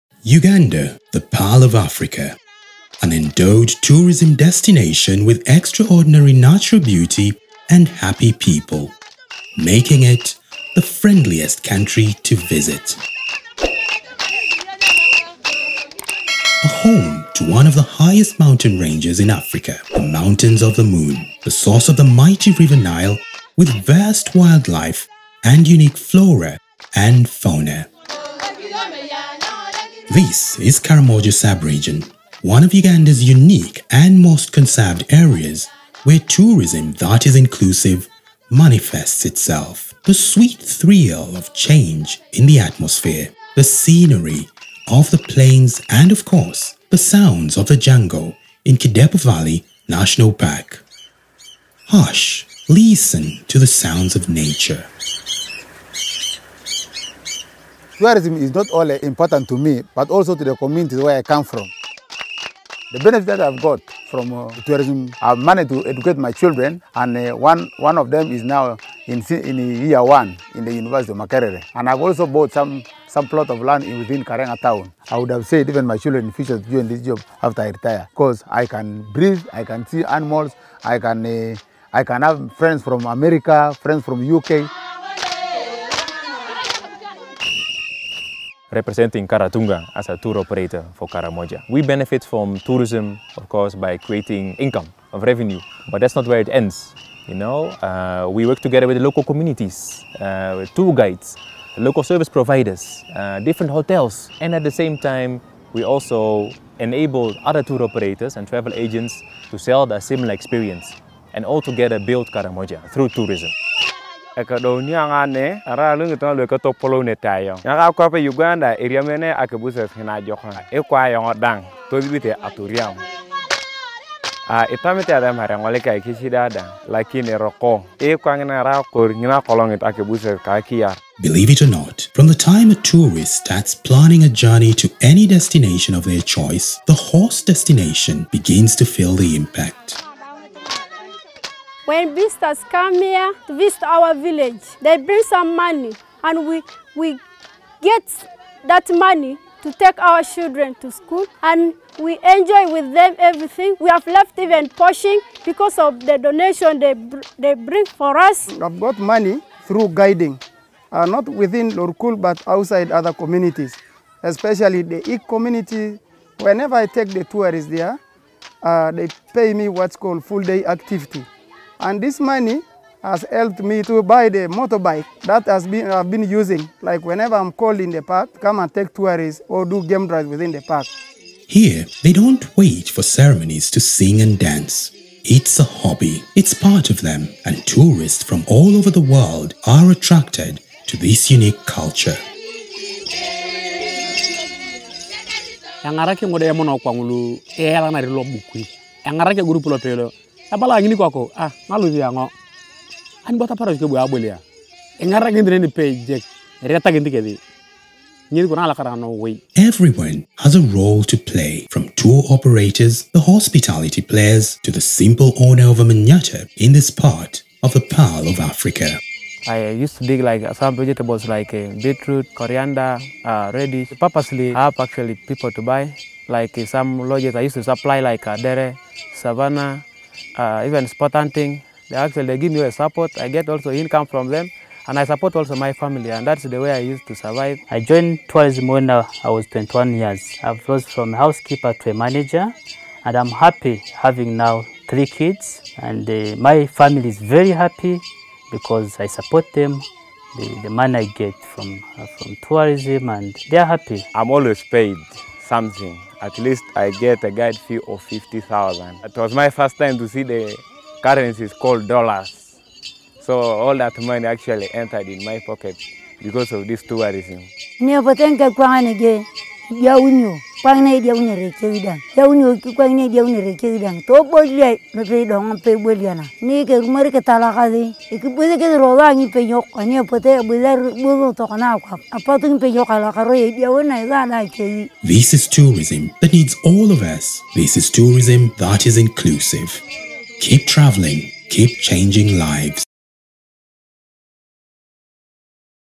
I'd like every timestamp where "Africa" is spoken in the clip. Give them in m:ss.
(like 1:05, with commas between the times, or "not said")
0:01, 0:19, 3:38.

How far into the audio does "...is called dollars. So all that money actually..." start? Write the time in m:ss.
4:21.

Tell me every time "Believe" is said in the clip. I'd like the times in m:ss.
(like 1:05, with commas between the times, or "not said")
2:11.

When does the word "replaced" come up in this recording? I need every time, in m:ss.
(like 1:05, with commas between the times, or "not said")
not said.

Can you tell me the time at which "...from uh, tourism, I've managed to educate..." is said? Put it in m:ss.
1:04.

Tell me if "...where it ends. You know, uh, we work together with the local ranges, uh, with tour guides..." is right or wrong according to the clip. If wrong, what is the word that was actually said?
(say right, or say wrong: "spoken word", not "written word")
wrong: "communities", not "ranges".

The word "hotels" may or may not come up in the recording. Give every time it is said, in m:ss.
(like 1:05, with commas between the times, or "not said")
1:43.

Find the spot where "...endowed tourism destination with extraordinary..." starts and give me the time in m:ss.
0:03.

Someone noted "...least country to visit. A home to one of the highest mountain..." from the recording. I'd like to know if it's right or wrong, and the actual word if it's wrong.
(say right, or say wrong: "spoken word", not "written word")
wrong: "friendliest", not "least".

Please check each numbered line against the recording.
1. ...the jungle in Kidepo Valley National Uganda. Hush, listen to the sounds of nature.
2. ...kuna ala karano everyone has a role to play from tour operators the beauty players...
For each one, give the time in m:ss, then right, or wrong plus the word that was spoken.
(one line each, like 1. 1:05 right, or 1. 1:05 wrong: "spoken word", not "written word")
1. 0:47 wrong: "Park", not "Uganda"
2. 3:28 wrong: "hospitality", not "beauty".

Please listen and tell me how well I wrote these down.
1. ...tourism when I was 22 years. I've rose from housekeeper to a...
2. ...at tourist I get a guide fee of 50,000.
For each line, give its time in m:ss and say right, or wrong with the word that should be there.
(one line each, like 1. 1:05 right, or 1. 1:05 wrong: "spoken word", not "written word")
1. 3:58 wrong: "21", not "22"
2. 4:16 wrong: "least", not "tourist".